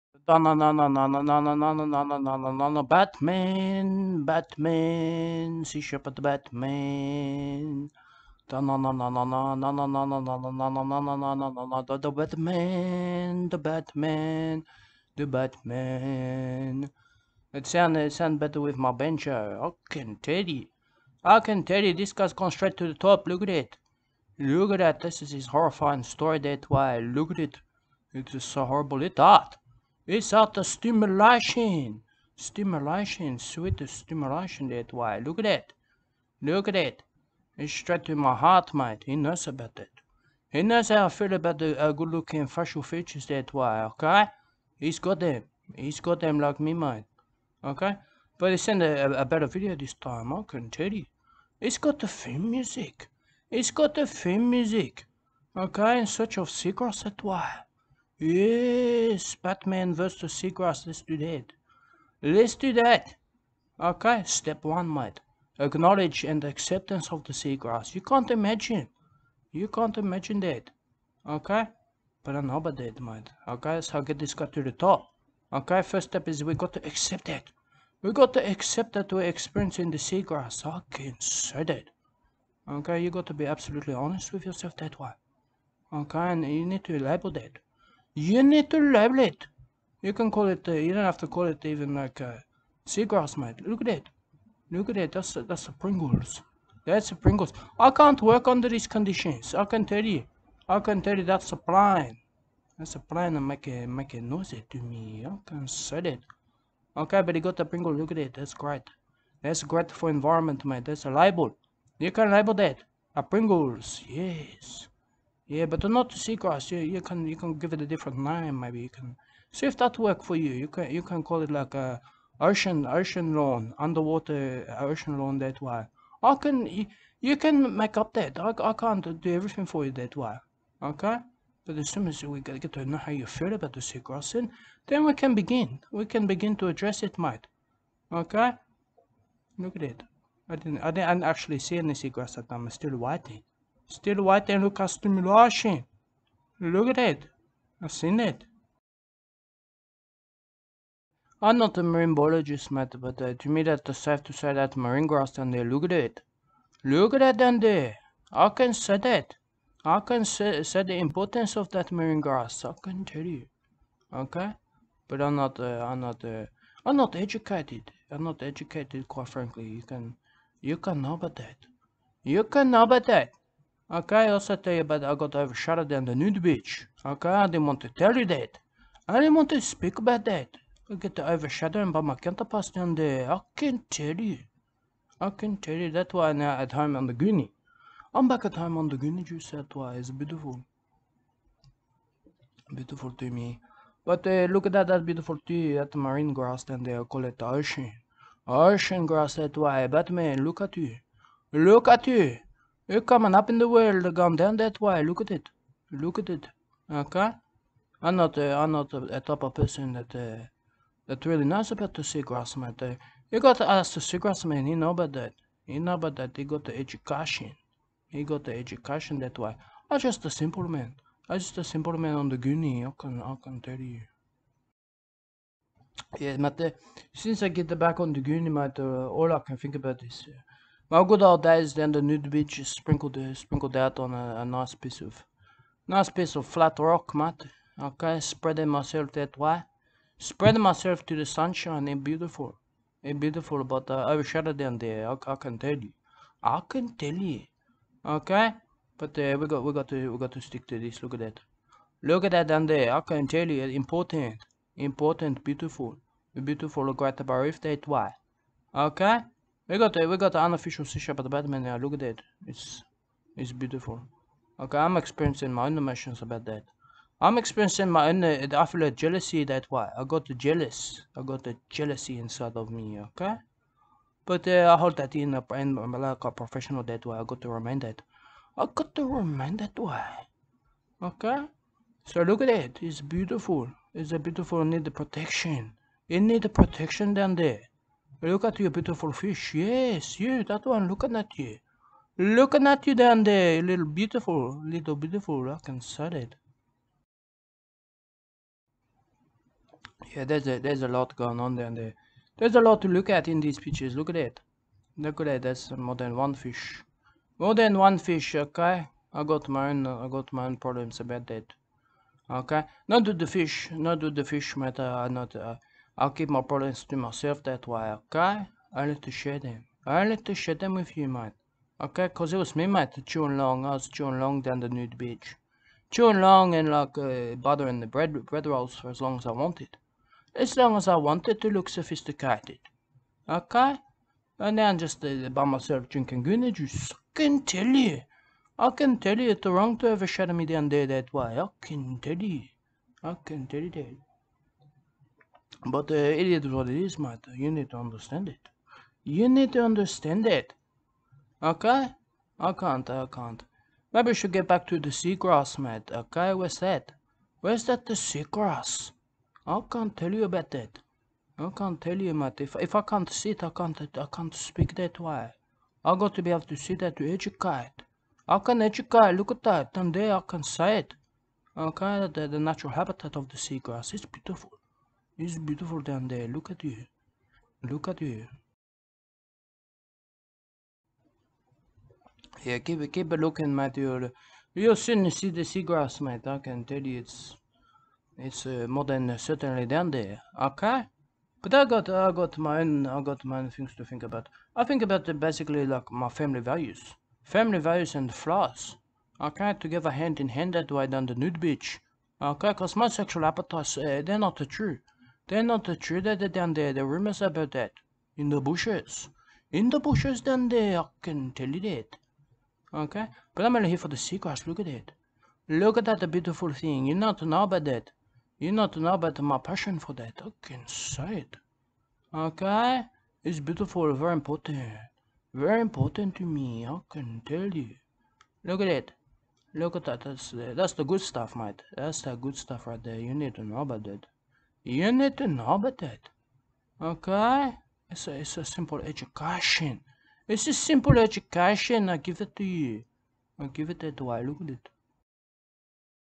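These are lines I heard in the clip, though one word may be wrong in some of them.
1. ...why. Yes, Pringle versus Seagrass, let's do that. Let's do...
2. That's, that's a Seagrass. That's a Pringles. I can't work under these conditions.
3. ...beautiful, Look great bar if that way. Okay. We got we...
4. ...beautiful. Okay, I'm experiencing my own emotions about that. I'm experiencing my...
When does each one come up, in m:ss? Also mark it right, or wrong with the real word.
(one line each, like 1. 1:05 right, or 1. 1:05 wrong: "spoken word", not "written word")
1. 0:57 wrong: "Batman", not "Pringle"
2. 1:35 wrong: "Pringles", not "Seagrass"
3. 4:16 right
4. 4:23 right.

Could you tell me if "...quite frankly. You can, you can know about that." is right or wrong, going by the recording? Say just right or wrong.
right.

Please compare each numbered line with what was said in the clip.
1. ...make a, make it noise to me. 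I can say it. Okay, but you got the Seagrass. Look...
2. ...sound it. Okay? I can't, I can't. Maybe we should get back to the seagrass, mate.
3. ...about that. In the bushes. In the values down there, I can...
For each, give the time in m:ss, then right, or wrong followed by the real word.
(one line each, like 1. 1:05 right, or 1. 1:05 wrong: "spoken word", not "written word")
1. 1:43 wrong: "Pringle", not "Seagrass"
2. 5:49 wrong: "understand", not "sound"
3. 6:47 wrong: "bushes", not "values".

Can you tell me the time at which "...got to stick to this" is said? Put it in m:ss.
4:10.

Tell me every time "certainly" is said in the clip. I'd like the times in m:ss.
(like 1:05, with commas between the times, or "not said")
6:29.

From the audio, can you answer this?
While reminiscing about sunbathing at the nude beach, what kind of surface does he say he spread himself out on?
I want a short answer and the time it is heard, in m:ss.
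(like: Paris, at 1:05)
flat rock, at 3:56.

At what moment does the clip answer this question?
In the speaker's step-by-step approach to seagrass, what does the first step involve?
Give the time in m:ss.
1:05.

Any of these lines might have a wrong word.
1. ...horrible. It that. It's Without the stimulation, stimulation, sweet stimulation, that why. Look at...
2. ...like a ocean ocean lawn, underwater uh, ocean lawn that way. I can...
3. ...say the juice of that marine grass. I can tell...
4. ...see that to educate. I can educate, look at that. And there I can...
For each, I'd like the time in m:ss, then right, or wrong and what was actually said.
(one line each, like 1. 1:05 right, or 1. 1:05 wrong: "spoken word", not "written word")
1. 0:28 right
2. 2:01 right
3. 2:40 wrong: "importance", not "juice"
4. 6:06 right.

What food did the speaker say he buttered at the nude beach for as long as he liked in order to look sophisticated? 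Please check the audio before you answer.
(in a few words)
bread rolls.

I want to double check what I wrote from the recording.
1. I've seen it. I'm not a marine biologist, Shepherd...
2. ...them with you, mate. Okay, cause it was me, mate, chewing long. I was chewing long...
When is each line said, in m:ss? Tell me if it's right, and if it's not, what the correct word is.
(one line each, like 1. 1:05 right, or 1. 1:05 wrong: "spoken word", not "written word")
1. 2:27 wrong: "Matt", not "Shepherd"
2. 5:20 right.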